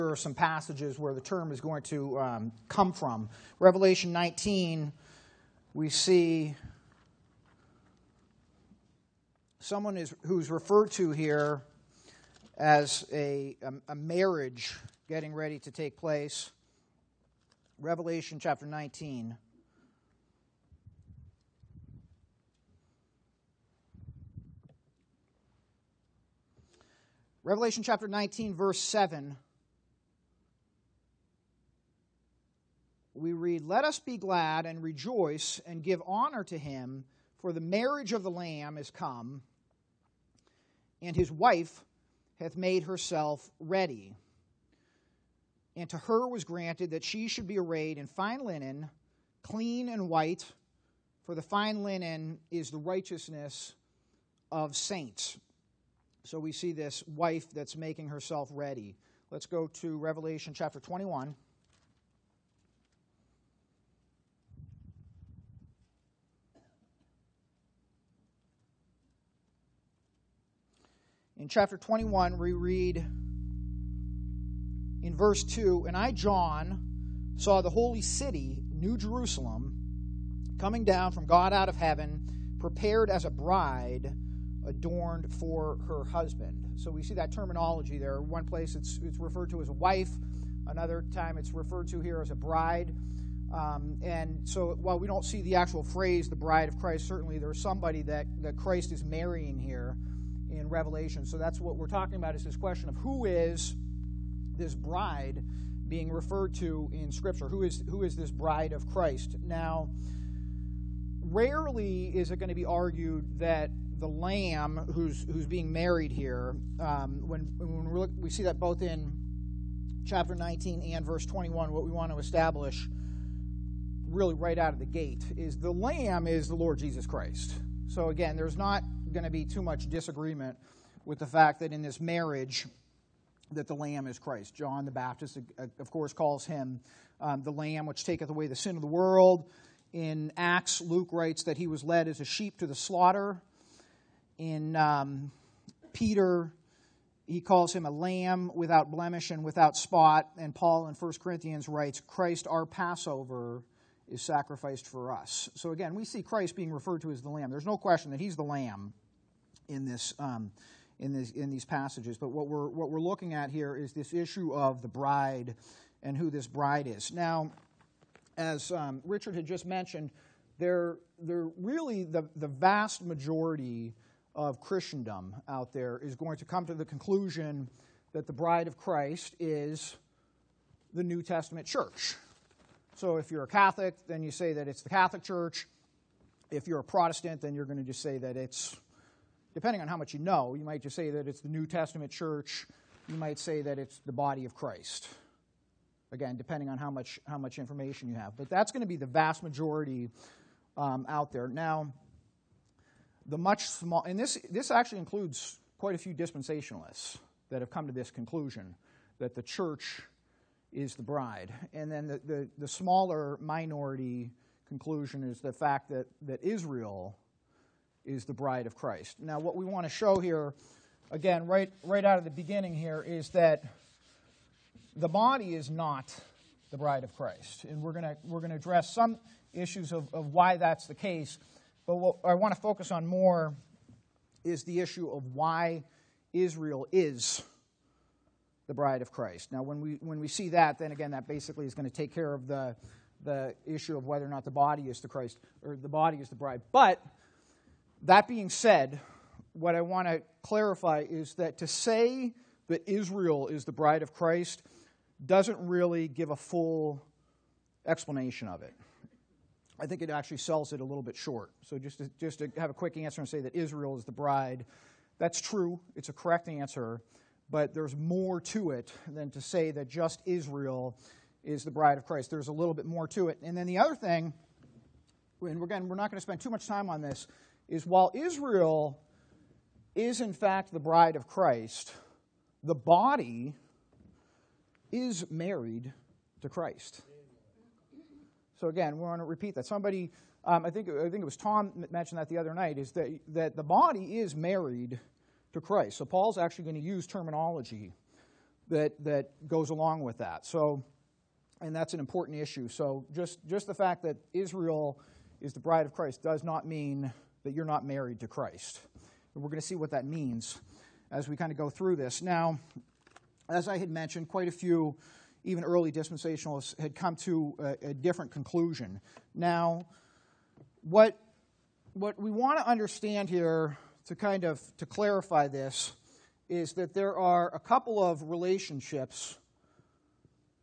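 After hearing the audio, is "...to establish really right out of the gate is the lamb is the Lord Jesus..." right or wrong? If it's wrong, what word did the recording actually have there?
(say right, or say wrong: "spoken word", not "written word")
right.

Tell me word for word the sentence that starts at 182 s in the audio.
So if you're a Catholic, then you say that it's the Catholic Church.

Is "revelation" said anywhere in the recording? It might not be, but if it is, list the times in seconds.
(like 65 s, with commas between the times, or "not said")
3 s, 17 s, 27 s, 59 s, 100 s.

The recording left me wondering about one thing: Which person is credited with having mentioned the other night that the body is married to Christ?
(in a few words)
Tom.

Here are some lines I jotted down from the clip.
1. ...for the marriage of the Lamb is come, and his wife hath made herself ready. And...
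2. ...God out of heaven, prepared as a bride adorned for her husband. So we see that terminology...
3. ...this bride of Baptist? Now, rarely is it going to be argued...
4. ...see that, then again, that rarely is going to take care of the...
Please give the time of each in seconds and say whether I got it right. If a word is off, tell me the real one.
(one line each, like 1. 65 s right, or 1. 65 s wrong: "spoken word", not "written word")
1. 37 s right
2. 81 s right
3. 108 s wrong: "Christ", not "Baptist"
4. 240 s wrong: "basically", not "rarely".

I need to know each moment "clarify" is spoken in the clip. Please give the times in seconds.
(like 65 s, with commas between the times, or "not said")
250 s, 324 s.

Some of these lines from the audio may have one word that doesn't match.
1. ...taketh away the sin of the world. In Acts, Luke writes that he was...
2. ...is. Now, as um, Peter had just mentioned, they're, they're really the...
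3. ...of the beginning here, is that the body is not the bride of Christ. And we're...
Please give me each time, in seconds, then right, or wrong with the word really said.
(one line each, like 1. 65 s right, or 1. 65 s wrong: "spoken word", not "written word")
1. 138 s right
2. 166 s wrong: "Richard", not "Peter"
3. 222 s right.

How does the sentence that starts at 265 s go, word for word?
It's a correct answer, but there's more to it than to say that just Israel is the bride of Christ.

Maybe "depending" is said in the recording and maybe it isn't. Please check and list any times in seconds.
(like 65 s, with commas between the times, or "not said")
189 s, 196 s.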